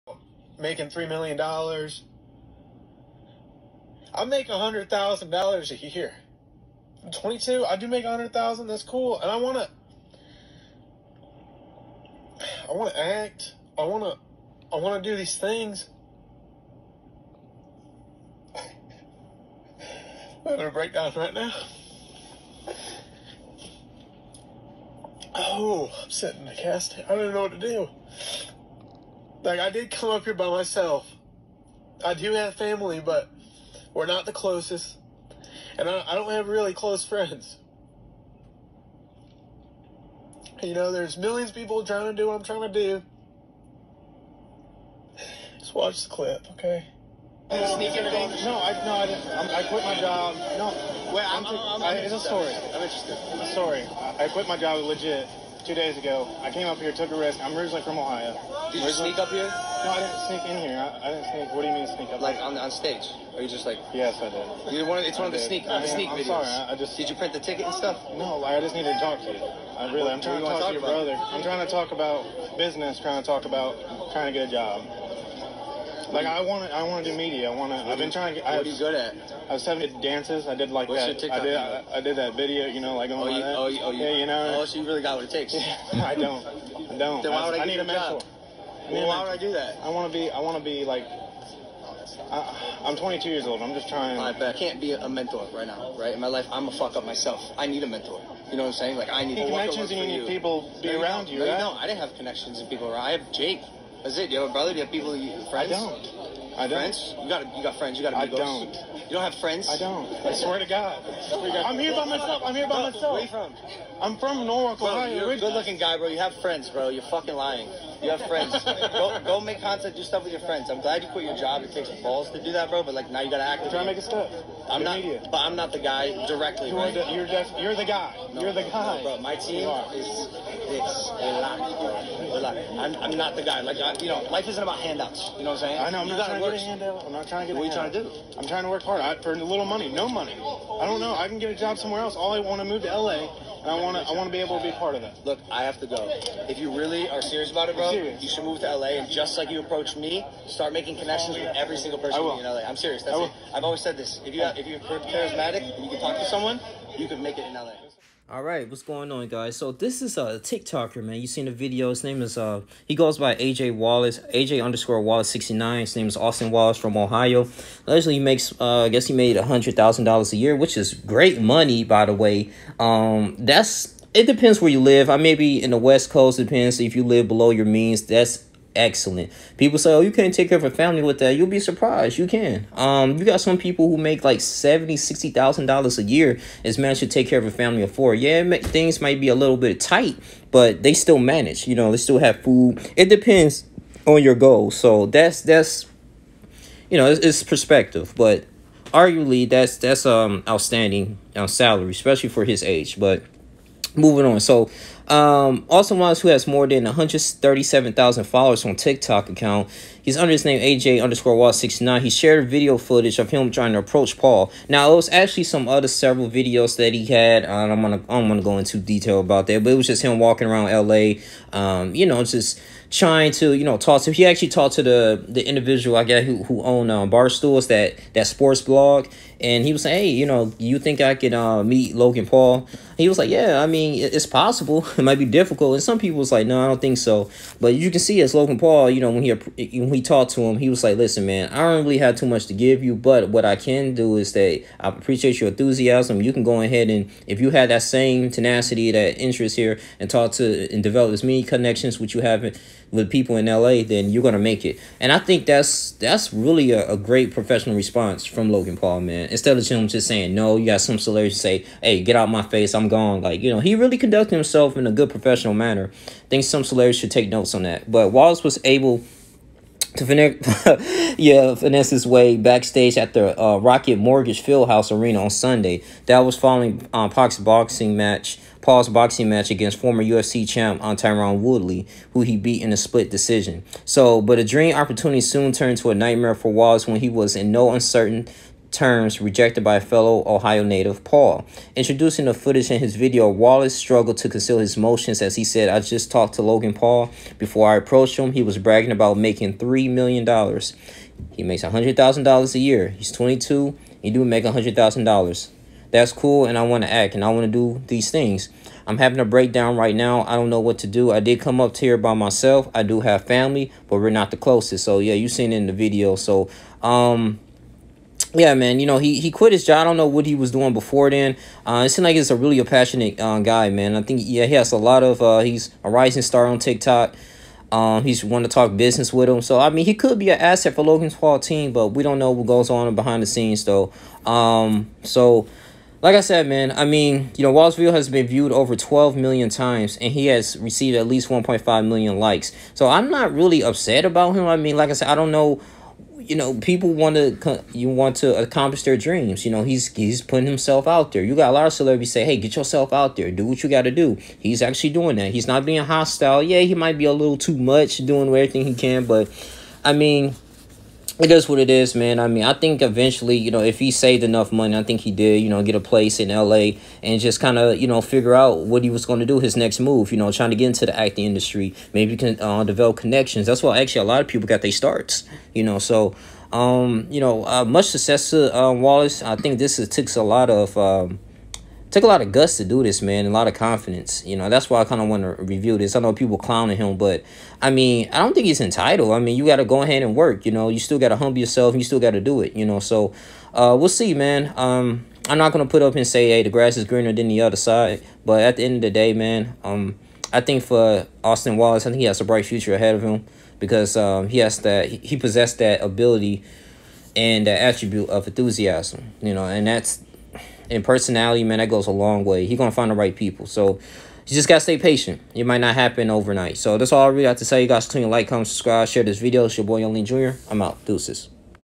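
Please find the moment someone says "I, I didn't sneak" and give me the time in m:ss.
1:00.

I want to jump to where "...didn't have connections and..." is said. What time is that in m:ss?
1:41.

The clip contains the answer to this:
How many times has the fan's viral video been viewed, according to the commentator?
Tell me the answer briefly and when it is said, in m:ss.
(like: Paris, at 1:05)
12 million, at 5:38.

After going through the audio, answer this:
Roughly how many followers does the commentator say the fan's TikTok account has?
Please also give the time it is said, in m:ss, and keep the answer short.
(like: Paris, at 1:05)
137,000, at 3:26.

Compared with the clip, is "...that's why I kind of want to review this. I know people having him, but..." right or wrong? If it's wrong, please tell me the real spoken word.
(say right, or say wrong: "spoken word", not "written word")
wrong: "clowning", not "having".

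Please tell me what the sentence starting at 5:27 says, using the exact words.
Um, he's wanting to talk business with him.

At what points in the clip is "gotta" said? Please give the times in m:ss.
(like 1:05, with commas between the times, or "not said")
2:03, 6:54.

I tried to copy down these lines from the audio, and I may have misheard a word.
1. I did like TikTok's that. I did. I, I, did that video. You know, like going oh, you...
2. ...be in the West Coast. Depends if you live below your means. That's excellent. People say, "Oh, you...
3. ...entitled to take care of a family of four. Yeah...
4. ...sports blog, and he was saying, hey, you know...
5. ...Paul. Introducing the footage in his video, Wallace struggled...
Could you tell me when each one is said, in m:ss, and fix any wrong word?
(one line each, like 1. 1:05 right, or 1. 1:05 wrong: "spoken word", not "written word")
1. 1:20 wrong: "What", not "TikTok"
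2. 2:55 right
3. 3:06 wrong: "managed", not "entitled"
4. 3:48 right
5. 4:51 right.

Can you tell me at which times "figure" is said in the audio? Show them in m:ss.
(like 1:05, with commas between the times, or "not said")
6:08.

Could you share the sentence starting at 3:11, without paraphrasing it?
You know, they still have food.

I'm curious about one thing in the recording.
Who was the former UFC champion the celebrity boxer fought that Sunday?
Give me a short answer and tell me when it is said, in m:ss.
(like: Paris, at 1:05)
Tyron Woodley, at 4:40.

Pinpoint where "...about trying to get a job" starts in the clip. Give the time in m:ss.
1:13.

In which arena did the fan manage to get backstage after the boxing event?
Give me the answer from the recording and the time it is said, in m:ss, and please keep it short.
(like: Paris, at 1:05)
Rocket Mortgage Fieldhouse, at 4:33.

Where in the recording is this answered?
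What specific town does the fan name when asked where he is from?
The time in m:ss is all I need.
1:54.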